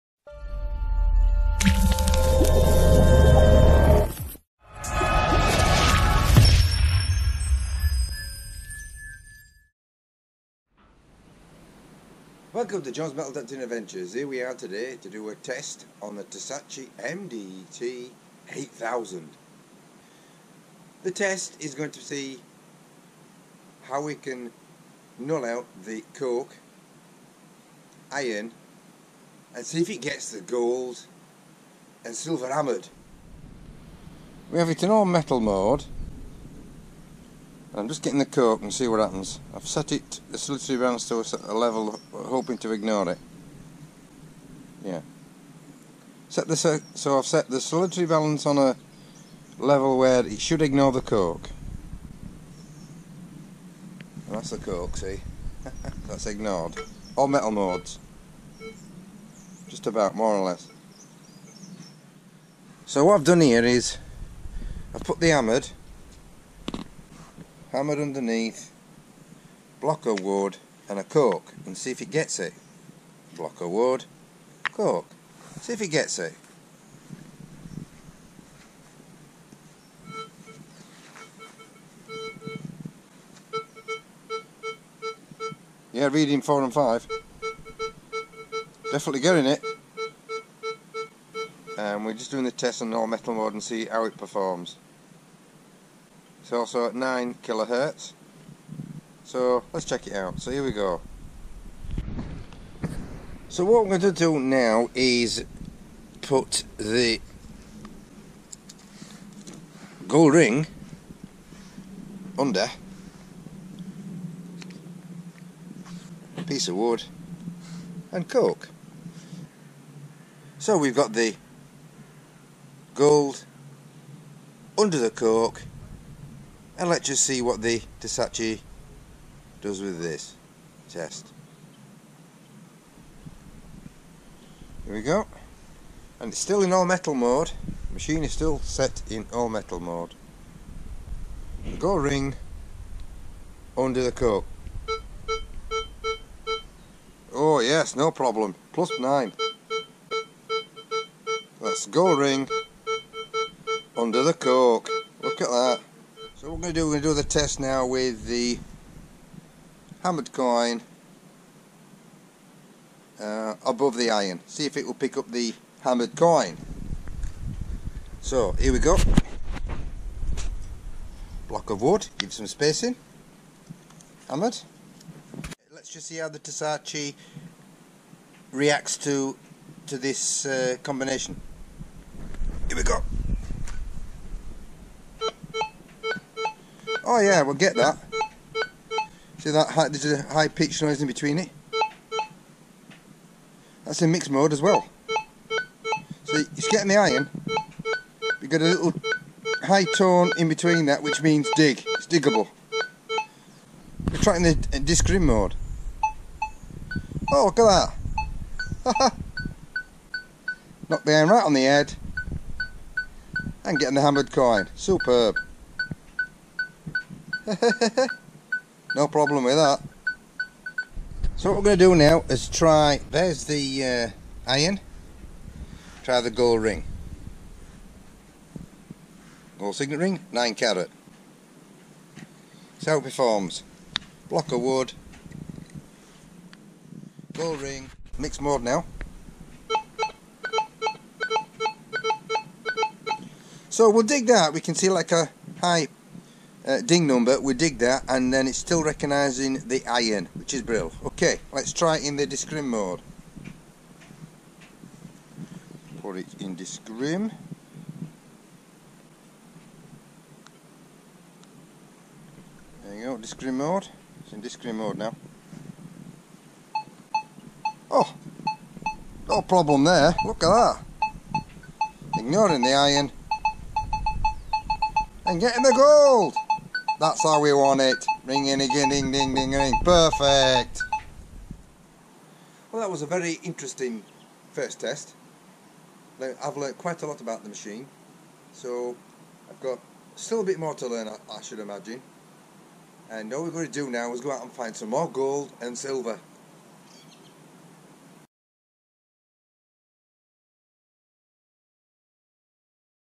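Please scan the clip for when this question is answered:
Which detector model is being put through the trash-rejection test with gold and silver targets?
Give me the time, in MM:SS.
00:16.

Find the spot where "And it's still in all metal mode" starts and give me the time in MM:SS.
02:16.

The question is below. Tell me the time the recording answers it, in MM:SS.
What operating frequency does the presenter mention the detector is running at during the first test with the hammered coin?
01:36.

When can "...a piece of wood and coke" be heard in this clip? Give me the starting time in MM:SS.
01:56.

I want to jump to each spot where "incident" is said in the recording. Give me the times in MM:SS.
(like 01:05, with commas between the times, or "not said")
not said.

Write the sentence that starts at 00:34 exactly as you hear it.
We have it in all metal mode.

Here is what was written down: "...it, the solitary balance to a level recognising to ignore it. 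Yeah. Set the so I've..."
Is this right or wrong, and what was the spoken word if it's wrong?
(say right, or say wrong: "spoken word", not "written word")
wrong: "hoping", not "recognising".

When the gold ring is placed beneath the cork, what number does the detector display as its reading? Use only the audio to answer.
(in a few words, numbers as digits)
plus 9.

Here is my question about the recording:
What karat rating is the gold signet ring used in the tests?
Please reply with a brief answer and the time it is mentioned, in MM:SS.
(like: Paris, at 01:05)
9 carat, at 03:50.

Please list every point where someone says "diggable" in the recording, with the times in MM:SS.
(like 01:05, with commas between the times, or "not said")
03:22.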